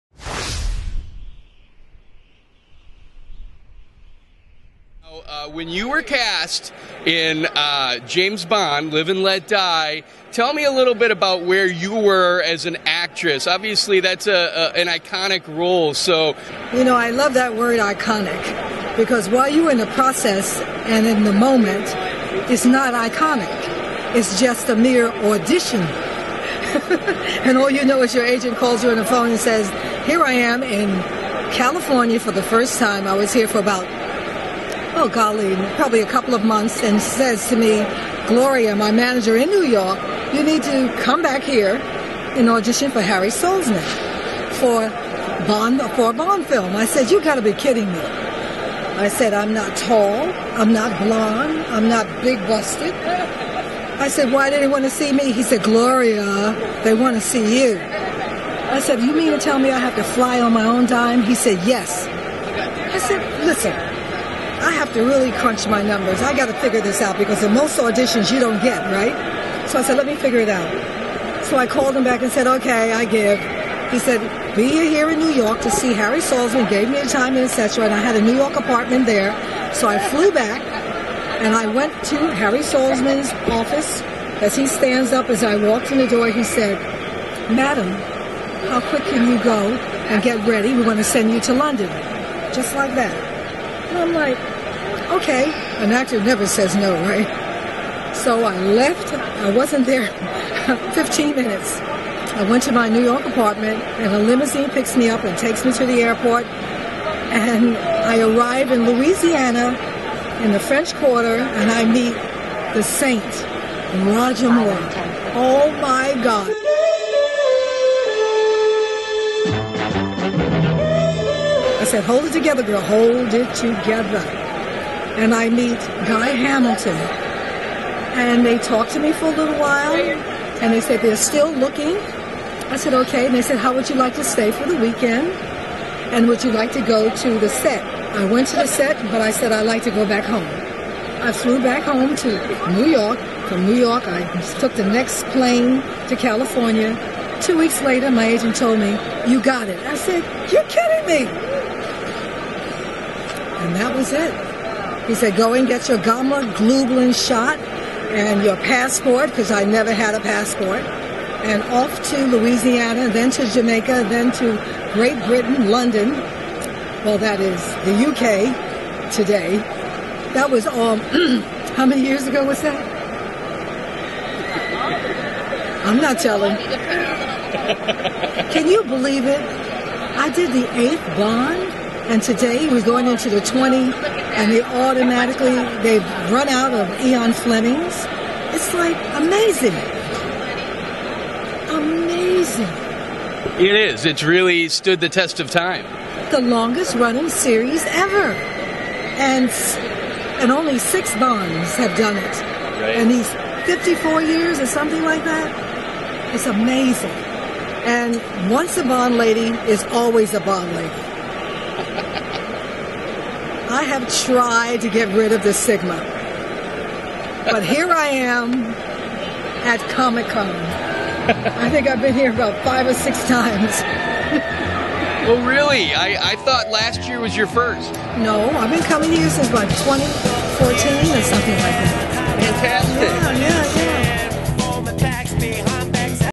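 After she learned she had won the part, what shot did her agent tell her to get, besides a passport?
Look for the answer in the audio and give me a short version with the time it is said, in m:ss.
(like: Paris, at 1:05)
Gamma globulin, at 2:35.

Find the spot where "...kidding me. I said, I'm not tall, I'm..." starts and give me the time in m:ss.
0:47.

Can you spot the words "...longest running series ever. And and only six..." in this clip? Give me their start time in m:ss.
3:16.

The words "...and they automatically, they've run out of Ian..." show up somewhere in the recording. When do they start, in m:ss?
3:03.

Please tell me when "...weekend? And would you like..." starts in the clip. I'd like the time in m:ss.
2:14.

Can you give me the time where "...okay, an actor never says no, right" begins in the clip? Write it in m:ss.
1:35.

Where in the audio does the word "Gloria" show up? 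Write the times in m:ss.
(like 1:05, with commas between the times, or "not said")
0:38, 0:55.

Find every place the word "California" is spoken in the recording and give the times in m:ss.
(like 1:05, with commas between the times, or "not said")
0:31, 2:26.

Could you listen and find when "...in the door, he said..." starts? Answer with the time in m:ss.
1:25.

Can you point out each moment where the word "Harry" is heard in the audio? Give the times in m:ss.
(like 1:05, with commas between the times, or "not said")
0:43, 1:15, 1:22.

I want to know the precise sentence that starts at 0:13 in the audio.
Obviously, that's a, a, an iconic role.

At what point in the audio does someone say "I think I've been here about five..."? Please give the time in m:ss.
3:40.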